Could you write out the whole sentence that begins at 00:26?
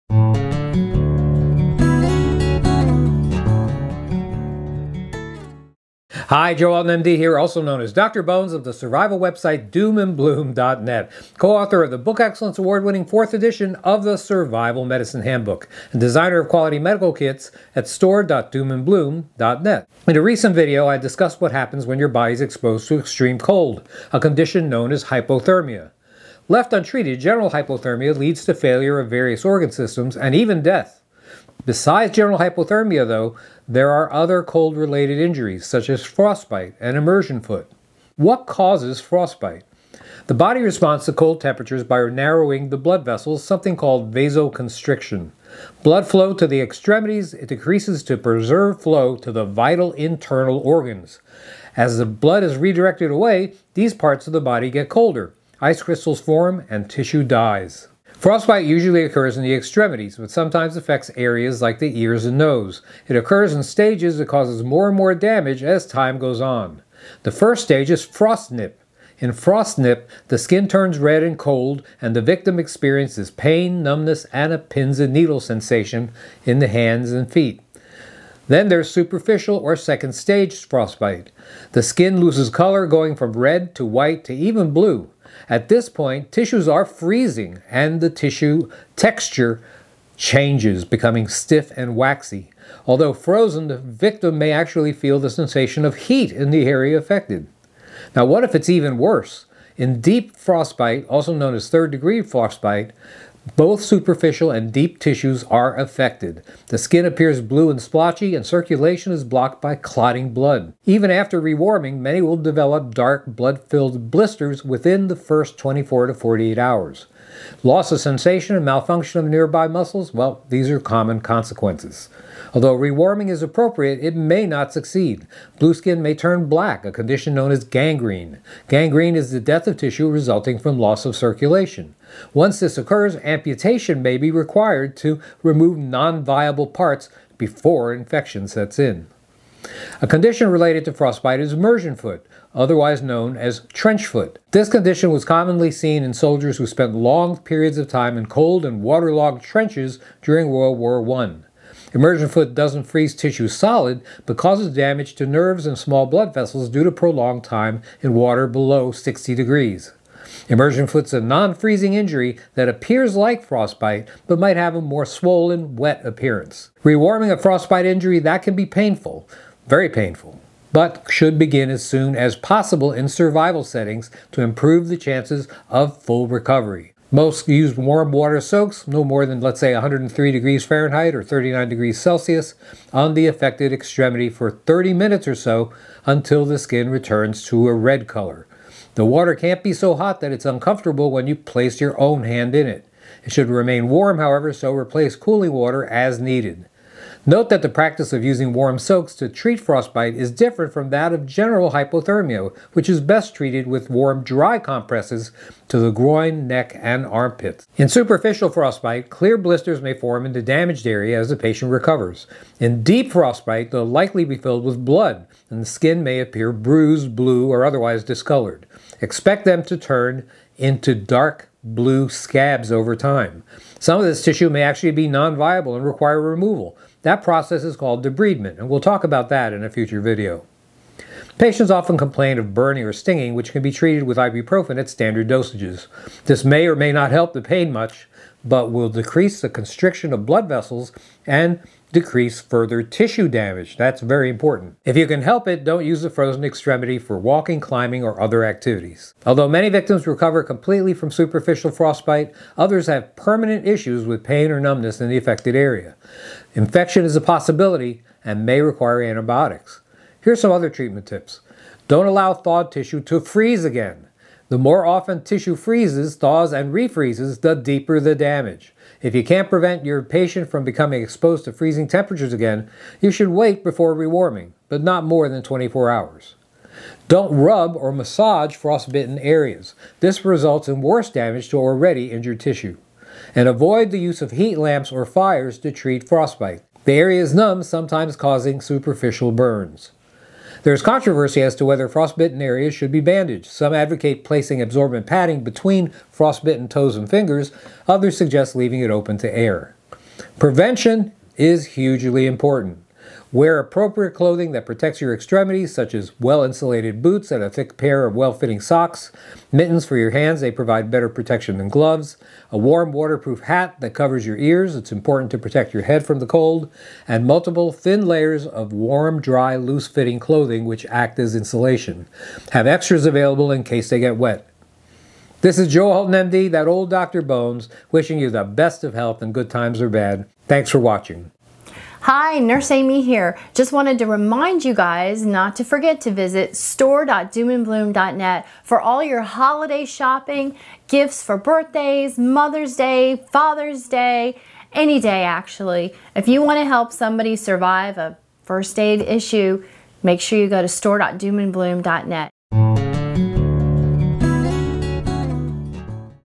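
Left untreated, general hypothermia leads to failure of various organ systems and even death.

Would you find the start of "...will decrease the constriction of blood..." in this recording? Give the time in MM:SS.
03:58.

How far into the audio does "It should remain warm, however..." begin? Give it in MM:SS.
03:13.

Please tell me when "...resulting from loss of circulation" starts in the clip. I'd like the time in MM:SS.
02:10.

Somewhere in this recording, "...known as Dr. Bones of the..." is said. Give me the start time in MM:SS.
00:07.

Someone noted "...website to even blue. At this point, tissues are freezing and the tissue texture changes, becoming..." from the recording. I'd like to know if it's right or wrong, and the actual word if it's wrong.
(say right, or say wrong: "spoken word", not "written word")
wrong: "white", not "website".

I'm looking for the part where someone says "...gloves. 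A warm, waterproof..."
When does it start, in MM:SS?
05:11.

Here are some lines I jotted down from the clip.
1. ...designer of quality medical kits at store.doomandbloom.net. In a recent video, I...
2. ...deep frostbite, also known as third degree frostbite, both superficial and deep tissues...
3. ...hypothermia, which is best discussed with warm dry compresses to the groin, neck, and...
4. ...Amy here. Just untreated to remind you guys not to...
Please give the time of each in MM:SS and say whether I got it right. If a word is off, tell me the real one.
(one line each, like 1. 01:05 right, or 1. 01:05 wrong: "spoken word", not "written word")
1. 00:15 right
2. 01:39 right
3. 03:21 wrong: "treated", not "discussed"
4. 05:32 wrong: "wanted", not "untreated".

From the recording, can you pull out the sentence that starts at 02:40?
Immersion foot's a non-freezing injury that appears like frostbite, but might have a more swollen, wet appearance.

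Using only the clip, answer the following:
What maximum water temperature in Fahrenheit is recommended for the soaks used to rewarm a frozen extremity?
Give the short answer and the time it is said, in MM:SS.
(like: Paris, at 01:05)
103 degrees Fahrenheit, at 02:59.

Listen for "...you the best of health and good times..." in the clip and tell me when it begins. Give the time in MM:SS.
05:28.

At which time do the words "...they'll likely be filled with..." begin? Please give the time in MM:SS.
03:33.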